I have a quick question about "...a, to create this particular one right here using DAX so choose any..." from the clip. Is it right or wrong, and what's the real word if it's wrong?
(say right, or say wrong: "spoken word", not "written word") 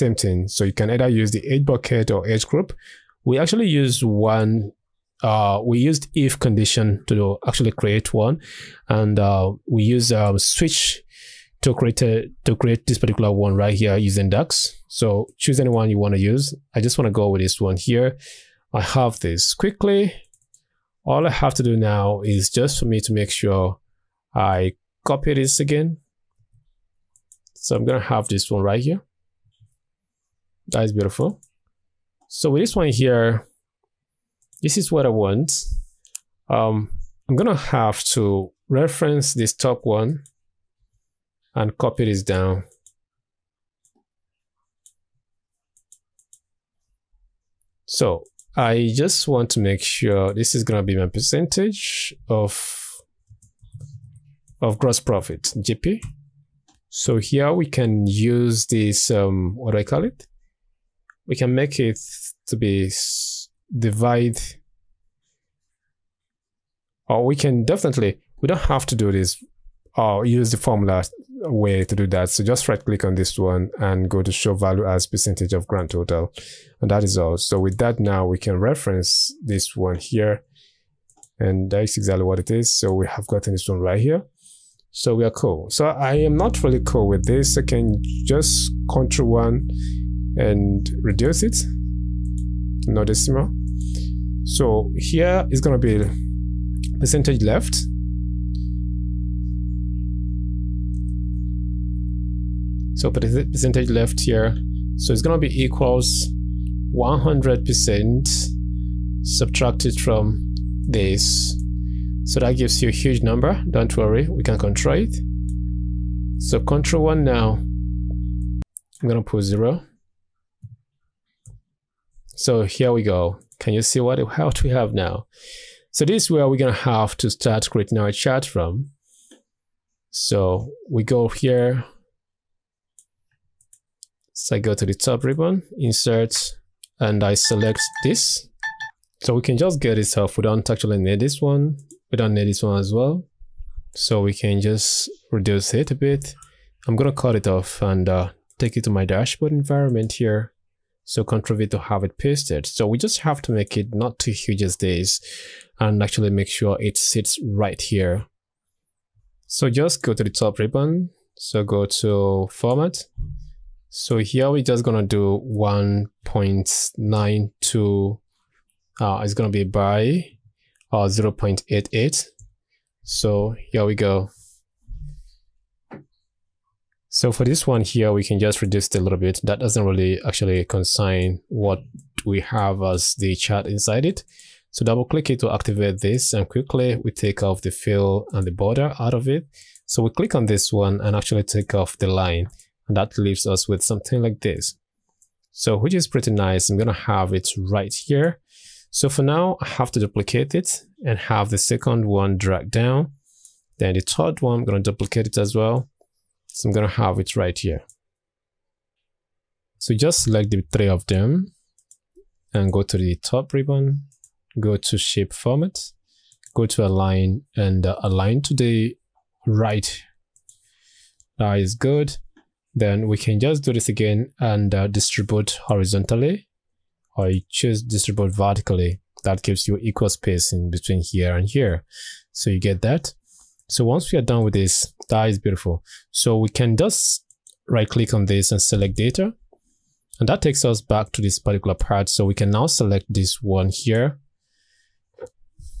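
right.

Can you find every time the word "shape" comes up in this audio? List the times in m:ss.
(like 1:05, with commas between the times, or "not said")
3:34.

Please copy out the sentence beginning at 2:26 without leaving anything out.
I'm gonna cut it off and uh, take it to my dashboard environment here.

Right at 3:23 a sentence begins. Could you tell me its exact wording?
Then the third one, I'm gonna duplicate it as well.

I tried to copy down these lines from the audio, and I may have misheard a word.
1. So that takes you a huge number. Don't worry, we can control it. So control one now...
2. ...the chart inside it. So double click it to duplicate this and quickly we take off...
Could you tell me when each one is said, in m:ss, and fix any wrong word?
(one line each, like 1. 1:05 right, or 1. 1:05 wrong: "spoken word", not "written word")
1. 1:52 wrong: "gives", not "takes"
2. 3:03 wrong: "activate", not "duplicate".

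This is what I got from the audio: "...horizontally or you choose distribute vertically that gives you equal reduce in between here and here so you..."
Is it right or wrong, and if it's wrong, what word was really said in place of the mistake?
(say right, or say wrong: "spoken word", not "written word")
wrong: "space", not "reduce".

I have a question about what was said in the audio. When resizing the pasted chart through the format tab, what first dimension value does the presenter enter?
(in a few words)
1.92.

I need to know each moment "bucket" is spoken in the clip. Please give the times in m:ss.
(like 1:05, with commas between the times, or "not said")
0:01.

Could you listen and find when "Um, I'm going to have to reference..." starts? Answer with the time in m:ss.
0:36.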